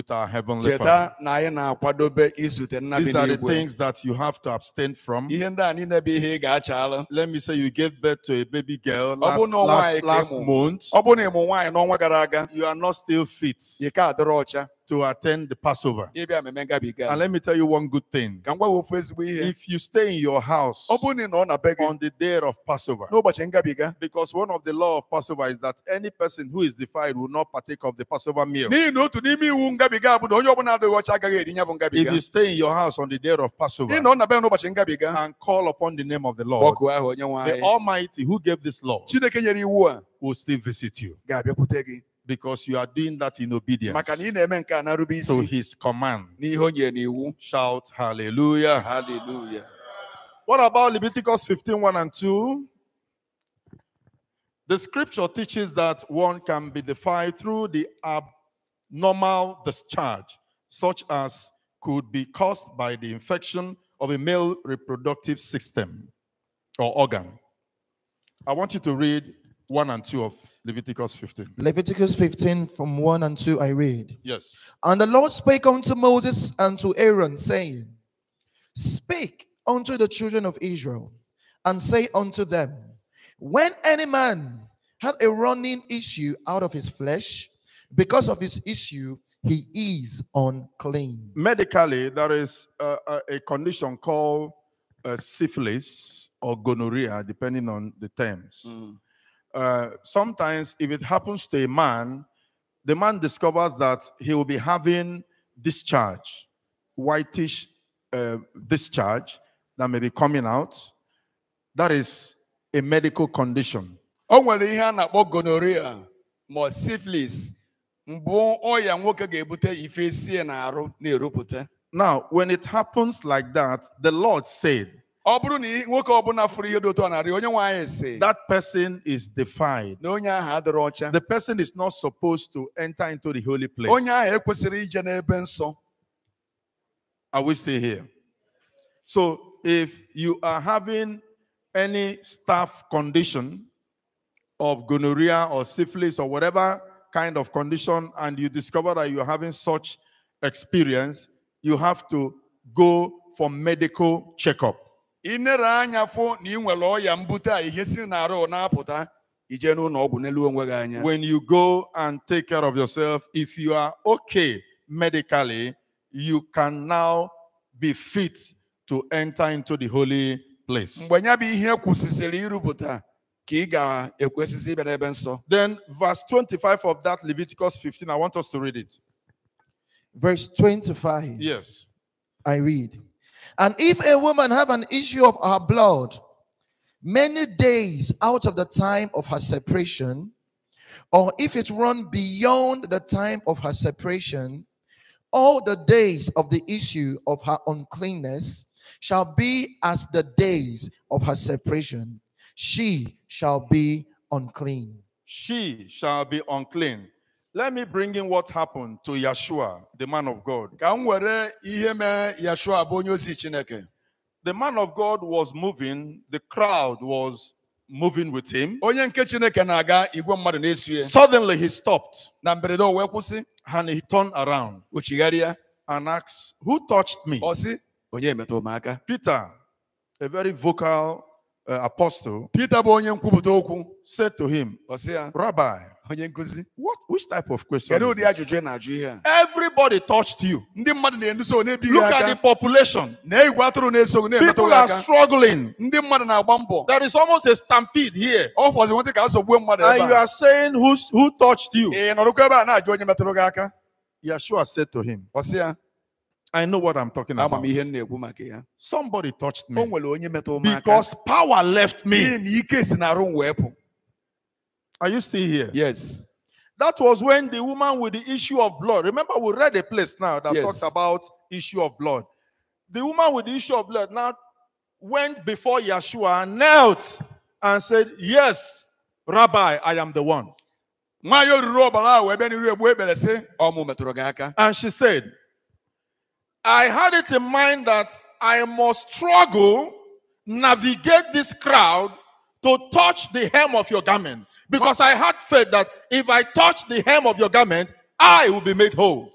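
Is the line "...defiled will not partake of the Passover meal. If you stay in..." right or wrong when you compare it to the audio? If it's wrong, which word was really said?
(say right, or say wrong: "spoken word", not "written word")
right.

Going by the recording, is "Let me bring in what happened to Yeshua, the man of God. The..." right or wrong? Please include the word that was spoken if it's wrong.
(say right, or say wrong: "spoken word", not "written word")
right.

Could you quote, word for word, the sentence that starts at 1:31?
Medically, there is a, a, condition called uh, syphilis or gonorrhea, depending on the terms.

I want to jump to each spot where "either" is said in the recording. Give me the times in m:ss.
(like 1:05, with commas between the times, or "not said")
not said.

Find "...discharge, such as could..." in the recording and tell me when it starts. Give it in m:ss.
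0:59.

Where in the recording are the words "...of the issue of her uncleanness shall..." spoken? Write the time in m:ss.
3:16.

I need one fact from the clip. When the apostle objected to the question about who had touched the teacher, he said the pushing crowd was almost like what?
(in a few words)
a stampede.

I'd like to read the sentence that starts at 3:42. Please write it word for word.
And he turned around and asked, Who touched me?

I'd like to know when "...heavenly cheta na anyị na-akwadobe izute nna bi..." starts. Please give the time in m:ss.
0:00.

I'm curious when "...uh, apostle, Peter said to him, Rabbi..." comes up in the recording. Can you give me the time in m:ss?
3:51.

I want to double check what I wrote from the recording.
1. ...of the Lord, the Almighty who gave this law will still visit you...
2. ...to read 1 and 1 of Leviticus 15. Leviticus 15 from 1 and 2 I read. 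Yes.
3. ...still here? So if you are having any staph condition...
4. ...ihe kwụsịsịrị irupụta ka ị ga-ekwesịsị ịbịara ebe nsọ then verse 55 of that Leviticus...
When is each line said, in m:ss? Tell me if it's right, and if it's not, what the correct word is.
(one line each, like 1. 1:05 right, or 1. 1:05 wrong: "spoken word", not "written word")
1. 0:36 right
2. 1:08 wrong: "2", not "1"
3. 2:17 right
4. 2:51 wrong: "25", not "55".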